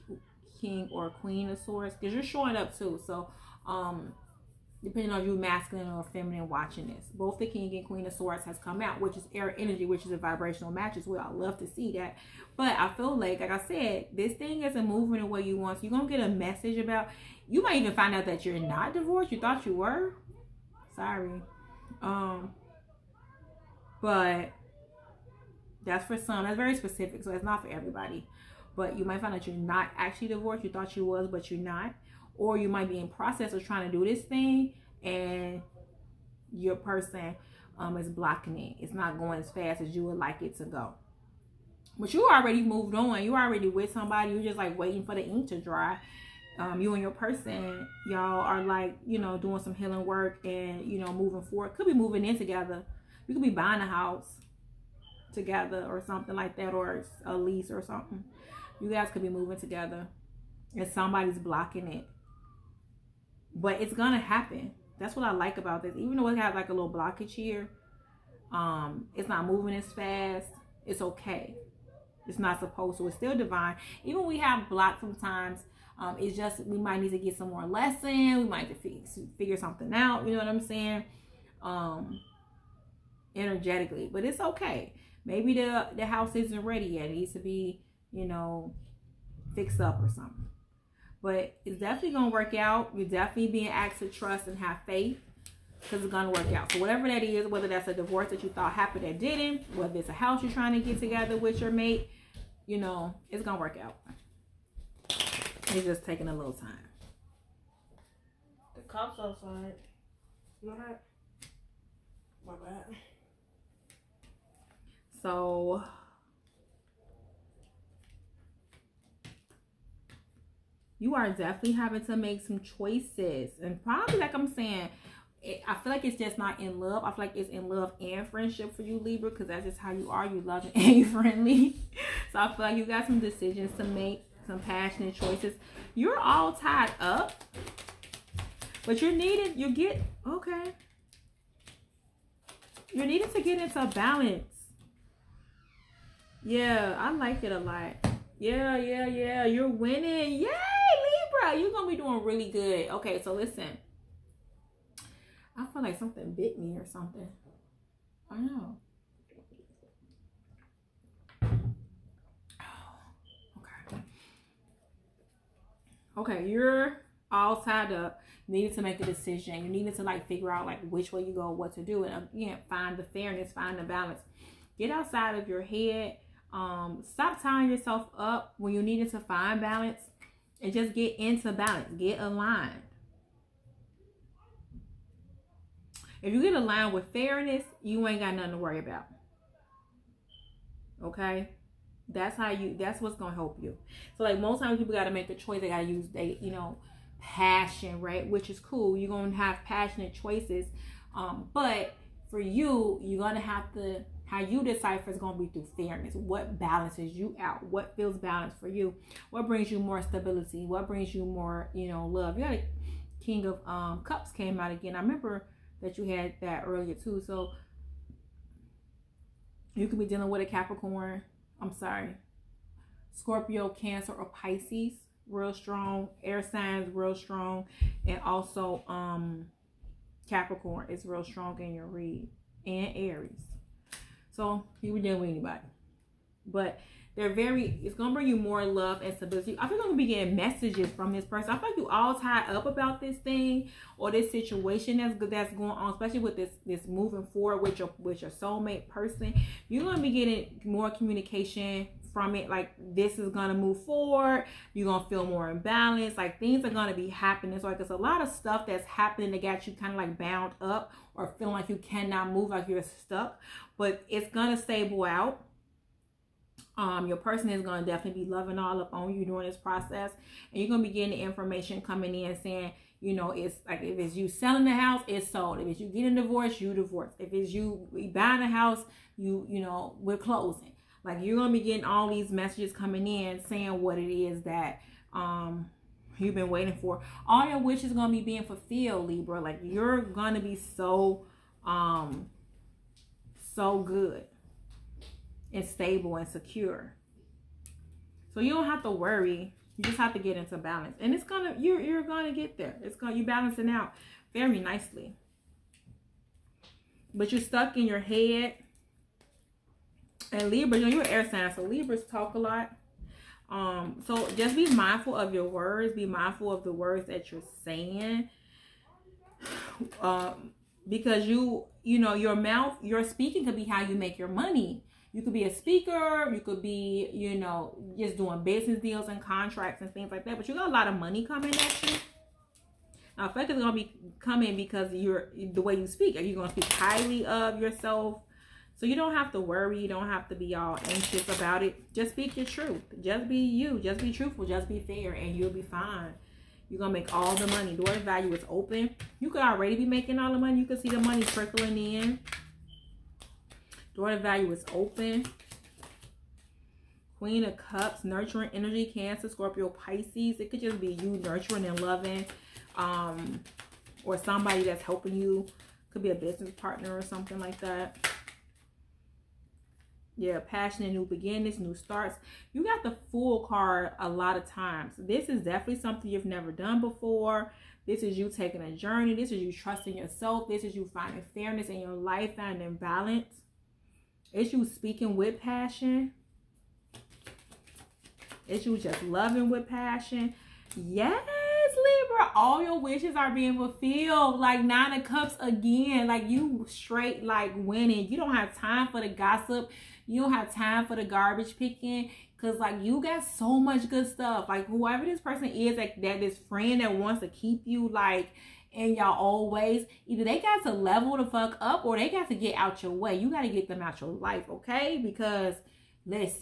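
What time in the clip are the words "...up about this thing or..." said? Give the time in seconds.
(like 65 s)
242 s.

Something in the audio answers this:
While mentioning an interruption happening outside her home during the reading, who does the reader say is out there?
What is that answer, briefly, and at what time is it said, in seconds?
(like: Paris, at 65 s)
The cops, at 108 s.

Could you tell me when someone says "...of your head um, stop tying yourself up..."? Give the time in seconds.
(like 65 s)
175 s.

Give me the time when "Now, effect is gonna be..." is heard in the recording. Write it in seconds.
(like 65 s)
333 s.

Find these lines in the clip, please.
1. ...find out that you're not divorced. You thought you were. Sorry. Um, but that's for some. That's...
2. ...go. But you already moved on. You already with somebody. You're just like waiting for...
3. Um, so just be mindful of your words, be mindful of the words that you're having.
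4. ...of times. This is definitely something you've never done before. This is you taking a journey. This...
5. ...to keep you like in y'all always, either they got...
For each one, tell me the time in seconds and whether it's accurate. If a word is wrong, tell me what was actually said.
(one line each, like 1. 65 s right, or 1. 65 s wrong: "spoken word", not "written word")
1. 17 s right
2. 40 s right
3. 313 s wrong: "saying", not "having"
4. 374 s right
5. 407 s right.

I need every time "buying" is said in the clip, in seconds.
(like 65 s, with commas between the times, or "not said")
53 s, 278 s.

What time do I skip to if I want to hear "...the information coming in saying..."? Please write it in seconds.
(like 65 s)
271 s.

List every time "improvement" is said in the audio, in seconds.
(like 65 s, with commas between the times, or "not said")
not said.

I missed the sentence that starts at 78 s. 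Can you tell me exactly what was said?
We might just figure something out.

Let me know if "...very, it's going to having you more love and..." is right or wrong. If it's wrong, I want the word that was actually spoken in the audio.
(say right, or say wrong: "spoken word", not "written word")
wrong: "bring", not "having".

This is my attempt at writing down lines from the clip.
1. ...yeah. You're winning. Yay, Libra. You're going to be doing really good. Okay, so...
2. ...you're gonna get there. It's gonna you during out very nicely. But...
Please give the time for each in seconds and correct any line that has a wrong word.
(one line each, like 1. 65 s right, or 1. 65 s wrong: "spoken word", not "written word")
1. 149 s right
2. 301 s wrong: "balancing", not "during".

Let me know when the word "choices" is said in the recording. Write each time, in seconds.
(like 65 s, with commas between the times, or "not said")
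122 s, 135 s, 195 s, 200 s.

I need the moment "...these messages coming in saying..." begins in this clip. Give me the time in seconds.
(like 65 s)
282 s.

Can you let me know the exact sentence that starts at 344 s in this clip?
Just be fair and you'll be fine.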